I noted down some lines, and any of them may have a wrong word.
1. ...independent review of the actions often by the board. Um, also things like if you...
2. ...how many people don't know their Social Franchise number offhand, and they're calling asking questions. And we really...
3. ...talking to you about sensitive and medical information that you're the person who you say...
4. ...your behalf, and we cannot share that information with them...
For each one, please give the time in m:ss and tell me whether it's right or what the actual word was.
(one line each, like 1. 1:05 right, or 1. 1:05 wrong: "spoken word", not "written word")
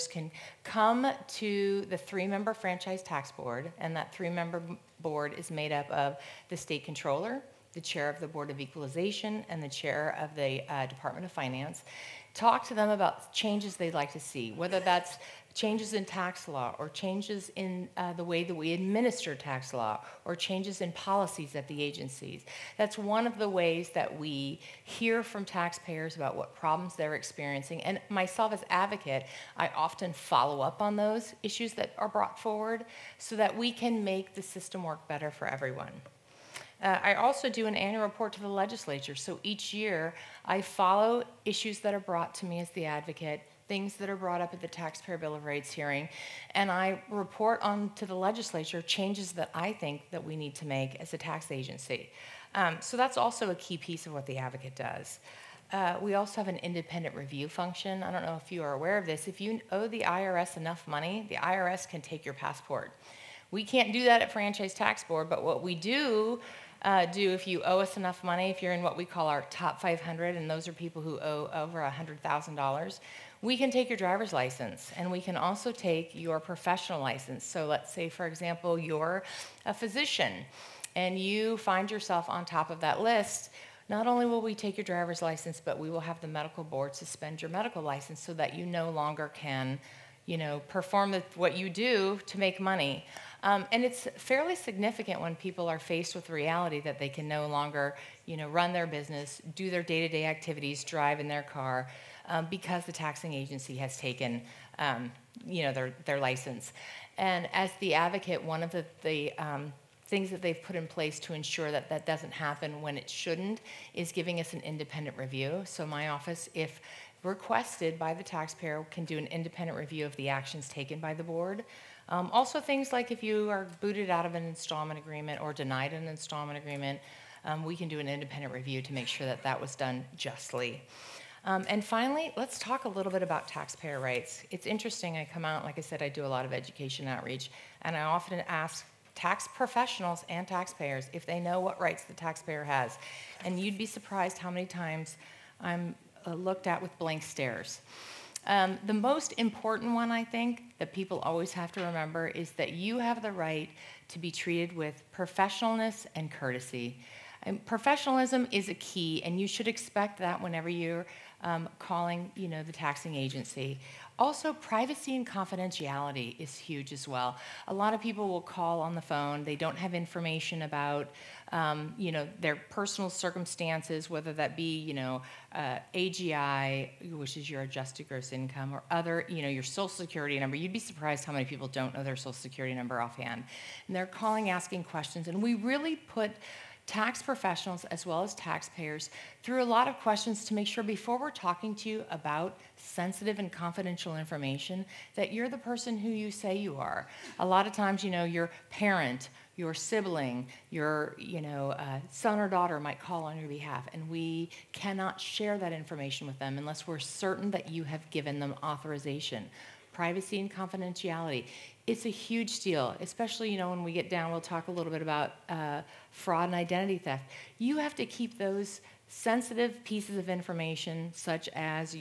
1. 1:59 wrong: "taken", not "often"
2. 3:01 wrong: "Security", not "Franchise"
3. 3:11 wrong: "confidential", not "medical"
4. 3:23 right.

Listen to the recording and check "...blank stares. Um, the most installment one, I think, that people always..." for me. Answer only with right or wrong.
wrong.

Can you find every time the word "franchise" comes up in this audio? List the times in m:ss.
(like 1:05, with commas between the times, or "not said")
0:02, 1:04.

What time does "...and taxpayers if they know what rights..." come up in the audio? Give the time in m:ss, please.
2:20.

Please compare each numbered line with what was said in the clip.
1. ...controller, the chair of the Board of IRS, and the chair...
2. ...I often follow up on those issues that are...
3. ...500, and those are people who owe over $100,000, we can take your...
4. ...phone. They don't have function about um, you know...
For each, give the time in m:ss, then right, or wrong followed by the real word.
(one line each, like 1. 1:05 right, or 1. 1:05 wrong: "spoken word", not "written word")
1. 0:06 wrong: "Equalization", not "IRS"
2. 0:29 right
3. 1:09 right
4. 2:49 wrong: "information", not "function".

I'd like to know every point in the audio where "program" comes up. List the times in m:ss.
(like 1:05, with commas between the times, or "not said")
not said.